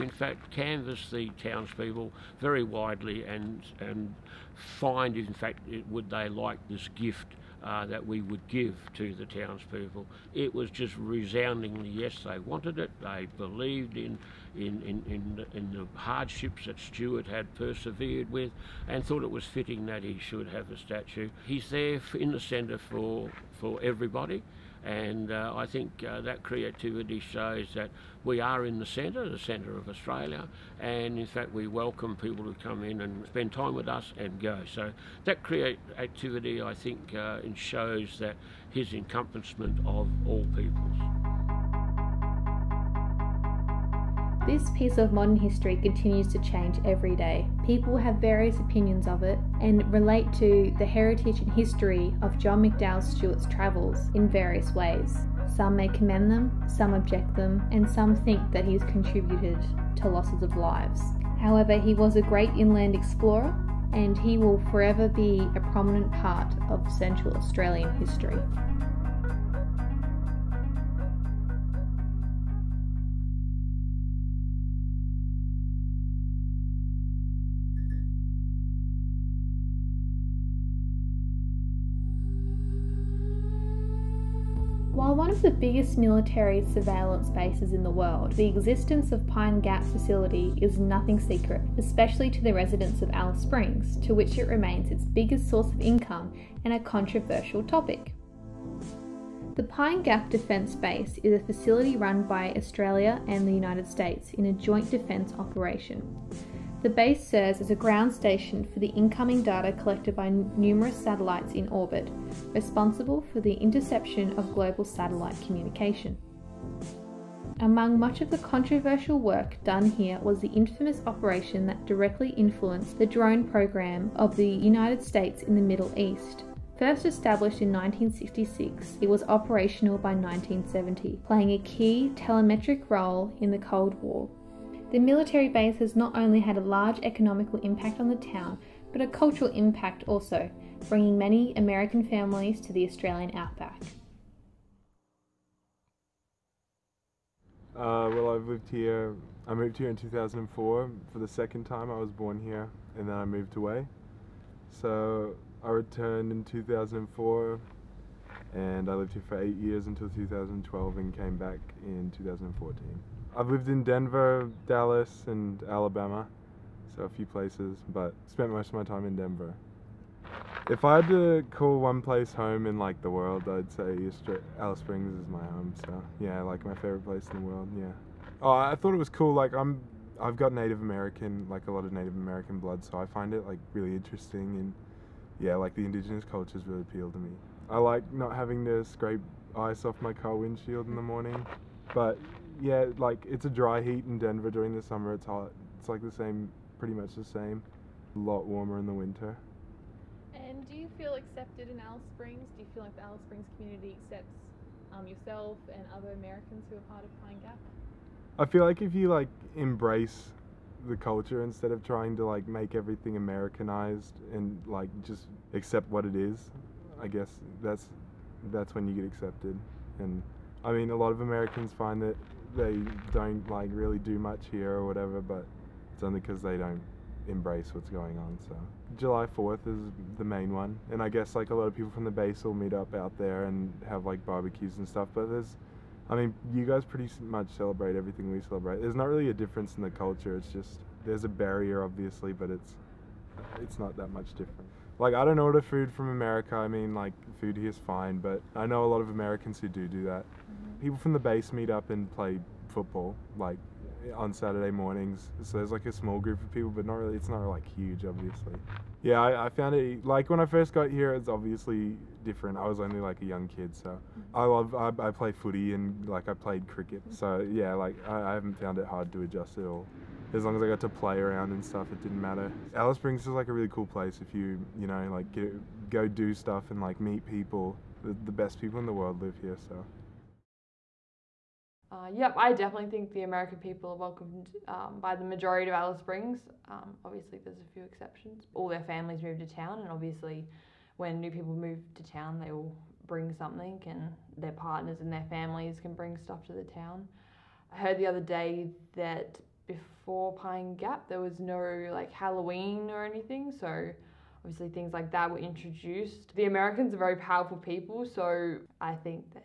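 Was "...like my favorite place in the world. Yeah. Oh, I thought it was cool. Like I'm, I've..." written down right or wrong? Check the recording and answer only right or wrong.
right.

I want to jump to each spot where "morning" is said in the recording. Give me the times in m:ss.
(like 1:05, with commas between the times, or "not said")
3:11, 4:14.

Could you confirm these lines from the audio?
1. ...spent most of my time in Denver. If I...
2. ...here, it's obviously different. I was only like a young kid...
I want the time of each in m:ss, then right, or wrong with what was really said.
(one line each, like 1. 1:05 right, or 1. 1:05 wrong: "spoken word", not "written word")
1. 2:48 right
2. 4:20 right.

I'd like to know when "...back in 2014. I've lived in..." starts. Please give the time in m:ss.
2:41.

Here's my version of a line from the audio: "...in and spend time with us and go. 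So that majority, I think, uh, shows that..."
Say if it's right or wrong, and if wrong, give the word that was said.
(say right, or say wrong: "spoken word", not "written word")
wrong: "creativity", not "majority".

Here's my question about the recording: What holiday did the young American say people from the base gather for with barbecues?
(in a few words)
July 4th.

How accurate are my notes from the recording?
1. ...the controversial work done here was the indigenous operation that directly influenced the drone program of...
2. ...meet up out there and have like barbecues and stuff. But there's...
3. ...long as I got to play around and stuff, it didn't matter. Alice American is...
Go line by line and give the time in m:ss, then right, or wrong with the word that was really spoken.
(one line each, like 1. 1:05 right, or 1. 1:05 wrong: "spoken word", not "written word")
1. 1:58 wrong: "infamous", not "indigenous"
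2. 3:52 right
3. 4:30 wrong: "Springs", not "American".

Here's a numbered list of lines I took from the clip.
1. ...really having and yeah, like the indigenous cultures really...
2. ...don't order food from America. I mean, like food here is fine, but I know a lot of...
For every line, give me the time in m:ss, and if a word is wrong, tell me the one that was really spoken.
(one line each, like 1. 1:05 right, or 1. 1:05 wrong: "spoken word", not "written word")
1. 3:03 wrong: "interesting", not "having"
2. 4:05 right.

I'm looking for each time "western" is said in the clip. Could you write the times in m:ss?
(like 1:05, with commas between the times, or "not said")
not said.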